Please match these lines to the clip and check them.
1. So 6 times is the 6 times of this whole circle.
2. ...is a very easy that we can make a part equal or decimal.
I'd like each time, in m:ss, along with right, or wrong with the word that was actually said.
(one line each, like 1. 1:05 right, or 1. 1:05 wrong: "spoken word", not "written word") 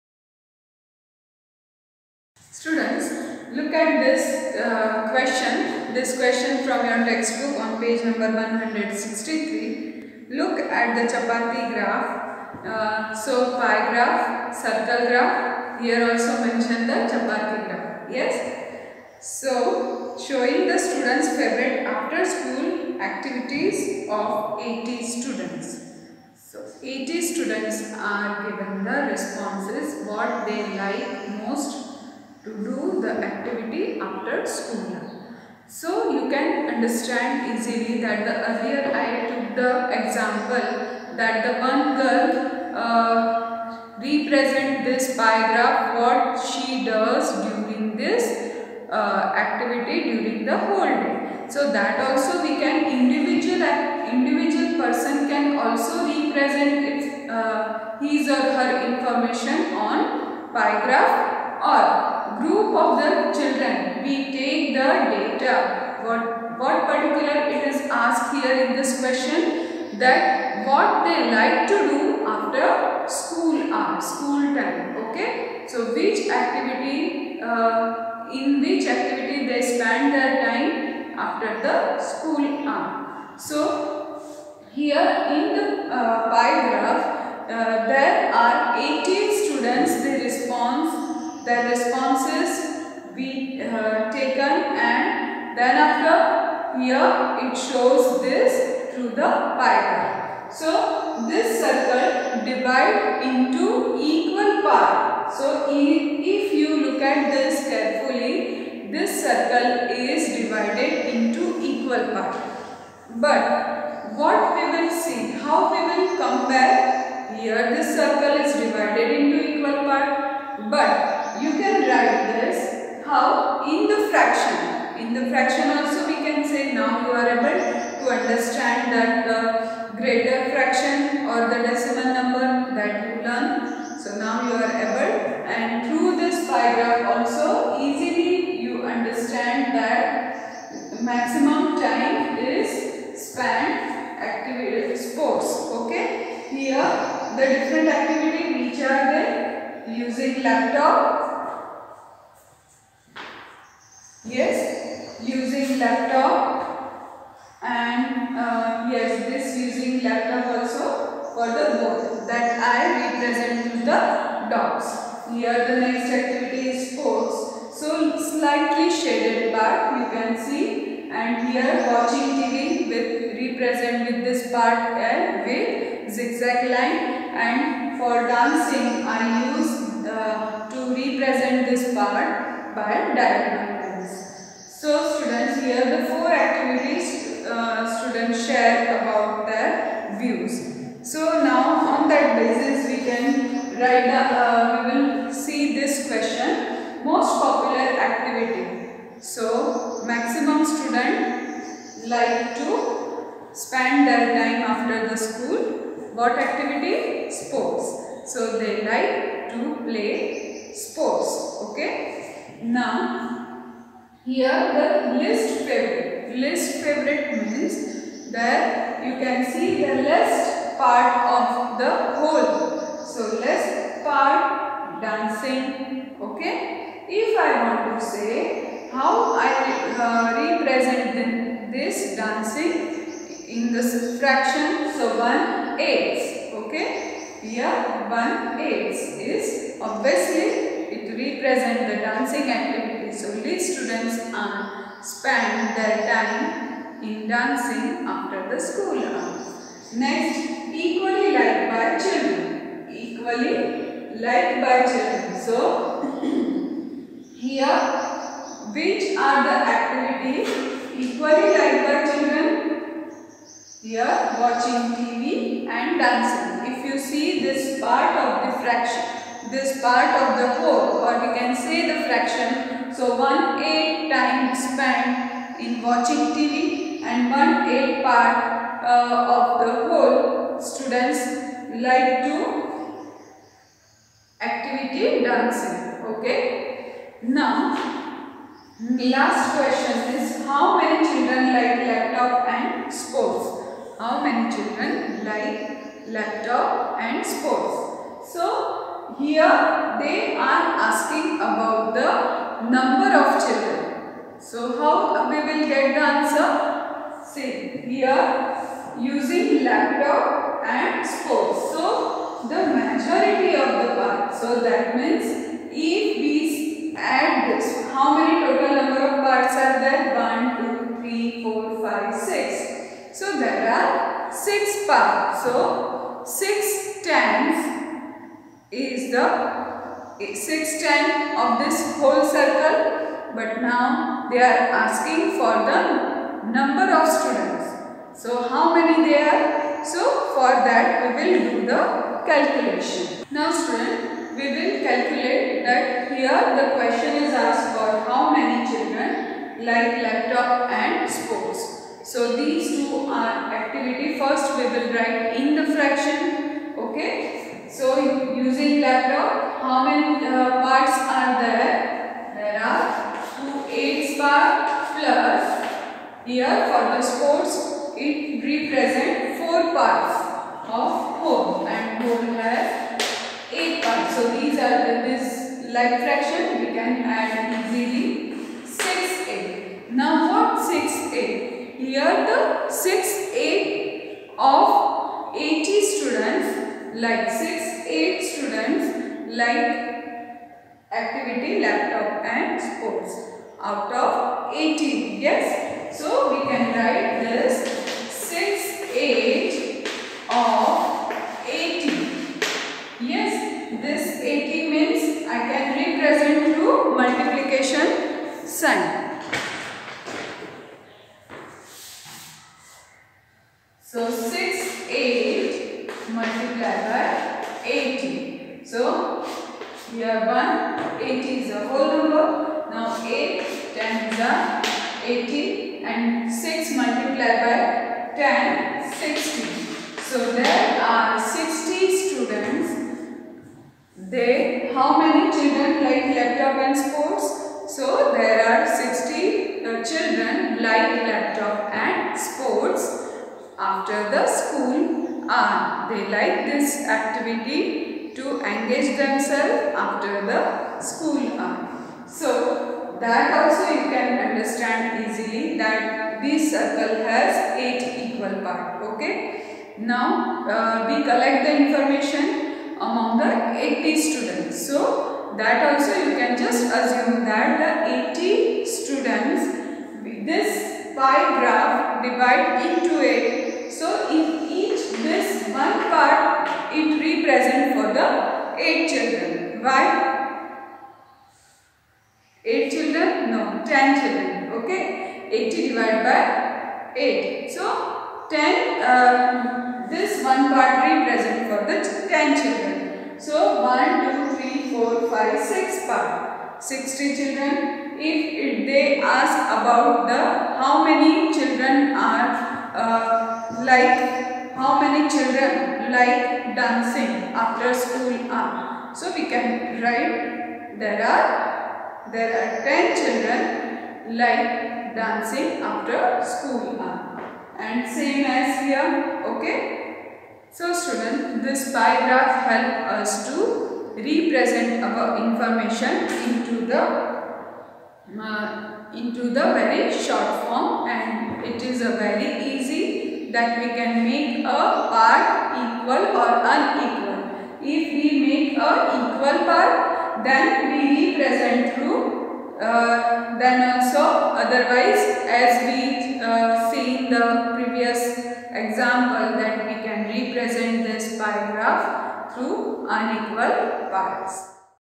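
1. 5:25 right
2. 8:51 wrong: "unequal", not "decimal".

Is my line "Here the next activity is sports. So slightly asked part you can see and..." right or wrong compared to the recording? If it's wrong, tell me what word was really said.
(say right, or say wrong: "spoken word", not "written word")
wrong: "shaded", not "asked".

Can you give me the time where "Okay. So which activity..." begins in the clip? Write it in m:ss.
1:15.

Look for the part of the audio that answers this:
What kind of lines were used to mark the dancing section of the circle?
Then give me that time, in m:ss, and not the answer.
3:03.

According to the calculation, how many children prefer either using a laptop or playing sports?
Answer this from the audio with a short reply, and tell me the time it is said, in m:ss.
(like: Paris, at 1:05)
60, at 7:11.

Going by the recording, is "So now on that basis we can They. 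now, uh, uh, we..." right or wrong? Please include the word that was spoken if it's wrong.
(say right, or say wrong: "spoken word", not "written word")
wrong: "Right", not "They".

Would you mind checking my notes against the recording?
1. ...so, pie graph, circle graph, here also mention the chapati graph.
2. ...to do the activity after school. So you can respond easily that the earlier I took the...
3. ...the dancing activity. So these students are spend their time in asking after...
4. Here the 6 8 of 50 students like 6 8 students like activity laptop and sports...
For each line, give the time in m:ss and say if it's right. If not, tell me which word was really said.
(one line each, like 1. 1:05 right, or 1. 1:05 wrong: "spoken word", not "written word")
1. 0:13 right
2. 0:32 wrong: "understand", not "respond"
3. 4:01 wrong: "dancing", not "asking"
4. 6:21 wrong: "80", not "50".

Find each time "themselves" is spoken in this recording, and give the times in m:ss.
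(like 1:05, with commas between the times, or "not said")
7:28.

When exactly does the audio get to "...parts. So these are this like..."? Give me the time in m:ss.
6:13.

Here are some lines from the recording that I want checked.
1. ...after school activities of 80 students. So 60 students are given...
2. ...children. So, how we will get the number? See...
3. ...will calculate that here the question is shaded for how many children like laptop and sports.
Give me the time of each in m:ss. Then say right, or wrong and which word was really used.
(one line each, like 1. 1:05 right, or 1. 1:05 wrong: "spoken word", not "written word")
1. 0:21 wrong: "80", not "60"
2. 5:03 wrong: "answer", not "number"
3. 5:44 wrong: "asked", not "shaded".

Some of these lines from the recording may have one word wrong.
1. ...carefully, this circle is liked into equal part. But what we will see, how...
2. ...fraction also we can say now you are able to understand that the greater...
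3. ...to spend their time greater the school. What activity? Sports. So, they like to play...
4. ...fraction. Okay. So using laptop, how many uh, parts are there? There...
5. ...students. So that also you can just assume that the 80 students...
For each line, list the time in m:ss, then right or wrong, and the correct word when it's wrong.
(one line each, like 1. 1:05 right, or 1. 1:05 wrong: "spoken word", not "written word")
1. 1:47 wrong: "divided", not "liked"
2. 2:05 right
3. 3:22 wrong: "after", not "greater"
4. 5:55 right
5. 7:43 right.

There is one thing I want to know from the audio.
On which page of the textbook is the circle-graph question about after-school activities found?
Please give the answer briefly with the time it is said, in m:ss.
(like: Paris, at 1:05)
163, at 0:08.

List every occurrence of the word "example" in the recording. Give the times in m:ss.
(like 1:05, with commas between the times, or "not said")
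0:40, 9:08.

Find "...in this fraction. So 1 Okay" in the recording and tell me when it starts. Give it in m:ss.
3:53.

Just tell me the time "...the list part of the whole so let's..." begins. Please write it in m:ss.
3:39.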